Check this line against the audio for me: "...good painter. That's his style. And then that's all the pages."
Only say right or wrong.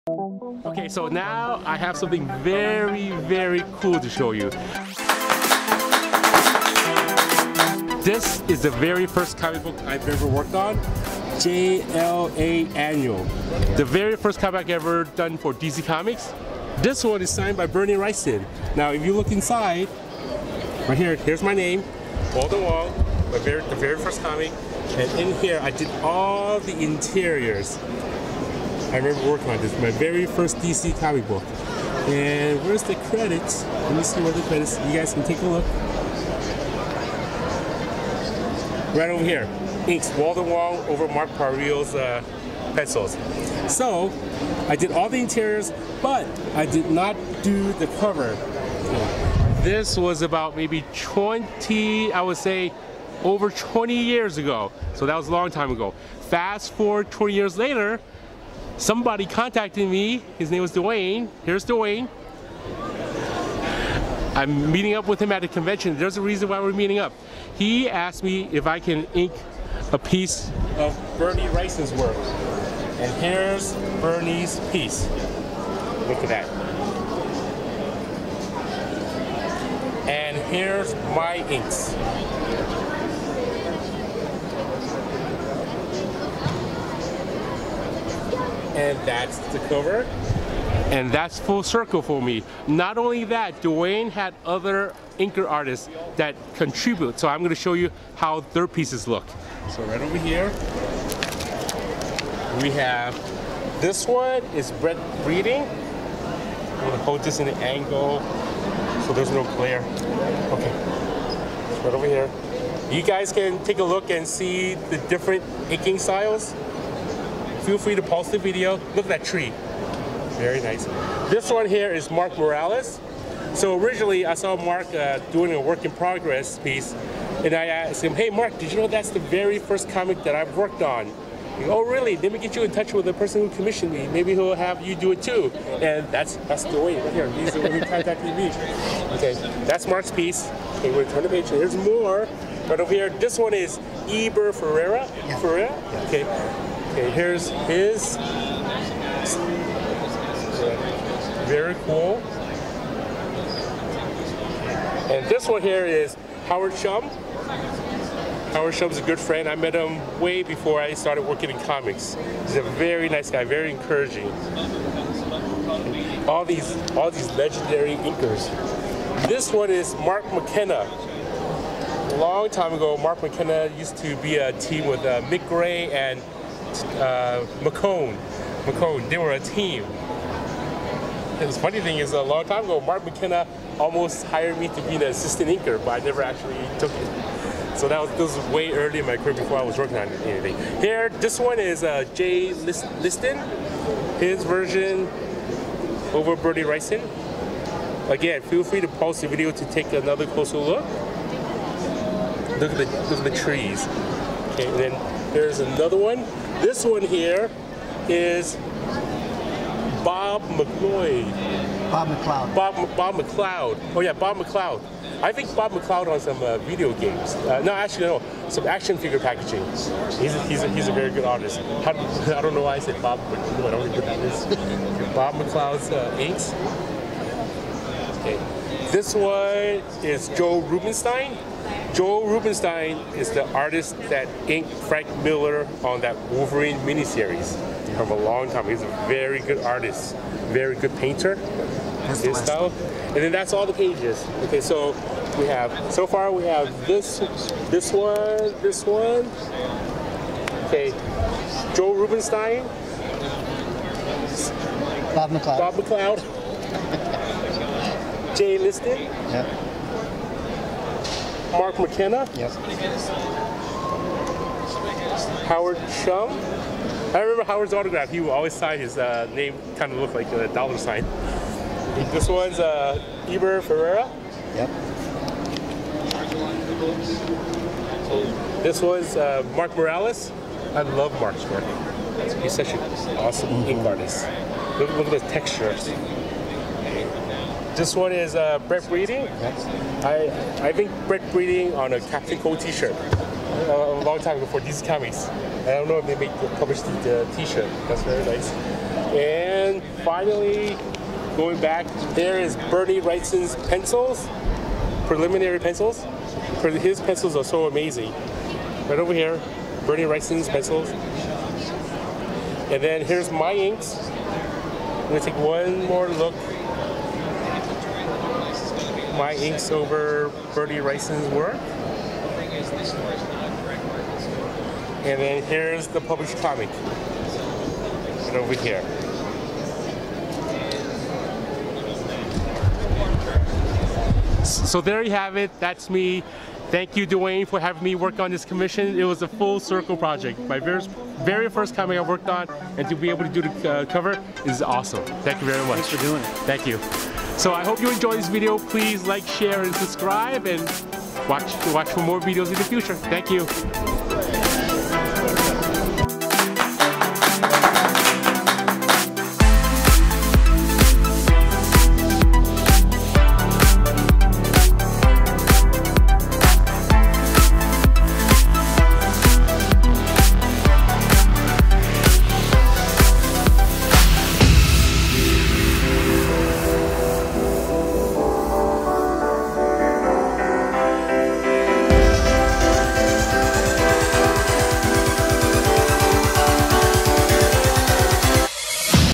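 right.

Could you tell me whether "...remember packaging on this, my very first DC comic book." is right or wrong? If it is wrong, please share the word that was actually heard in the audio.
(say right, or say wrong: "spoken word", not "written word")
wrong: "working", not "packaging".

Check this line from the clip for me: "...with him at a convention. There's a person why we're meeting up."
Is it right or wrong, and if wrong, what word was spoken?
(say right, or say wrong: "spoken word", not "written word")
wrong: "reason", not "person".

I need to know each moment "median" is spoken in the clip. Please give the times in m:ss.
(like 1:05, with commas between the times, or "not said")
not said.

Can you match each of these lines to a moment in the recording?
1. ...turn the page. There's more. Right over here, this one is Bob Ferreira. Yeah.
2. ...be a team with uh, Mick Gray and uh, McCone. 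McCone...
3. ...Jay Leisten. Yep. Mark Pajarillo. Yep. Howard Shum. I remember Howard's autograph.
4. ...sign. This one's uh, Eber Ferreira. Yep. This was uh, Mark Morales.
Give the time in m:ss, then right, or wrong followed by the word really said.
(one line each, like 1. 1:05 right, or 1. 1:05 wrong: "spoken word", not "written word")
1. 2:21 wrong: "Eber", not "Bob"
2. 2:54 right
3. 4:18 wrong: "McKenna", not "Pajarillo"
4. 4:30 right.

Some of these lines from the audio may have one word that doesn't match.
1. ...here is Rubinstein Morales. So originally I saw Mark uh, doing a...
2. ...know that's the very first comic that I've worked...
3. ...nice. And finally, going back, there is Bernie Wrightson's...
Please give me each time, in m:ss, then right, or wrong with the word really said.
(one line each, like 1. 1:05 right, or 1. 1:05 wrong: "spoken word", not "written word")
1. 2:01 wrong: "Mark", not "Rubinstein"
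2. 2:08 right
3. 4:58 right.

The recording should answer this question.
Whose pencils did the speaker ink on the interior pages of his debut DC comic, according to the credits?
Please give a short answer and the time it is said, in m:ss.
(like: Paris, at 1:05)
Mark Pajarillo, at 0:41.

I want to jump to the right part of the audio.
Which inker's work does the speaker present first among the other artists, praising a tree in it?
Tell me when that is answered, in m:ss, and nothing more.
1:44.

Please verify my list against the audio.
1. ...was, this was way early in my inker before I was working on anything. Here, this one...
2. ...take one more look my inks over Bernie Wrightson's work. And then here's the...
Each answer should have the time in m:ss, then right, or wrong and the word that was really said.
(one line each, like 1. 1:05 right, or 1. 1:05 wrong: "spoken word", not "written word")
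1. 3:07 wrong: "career", not "inker"
2. 5:15 right.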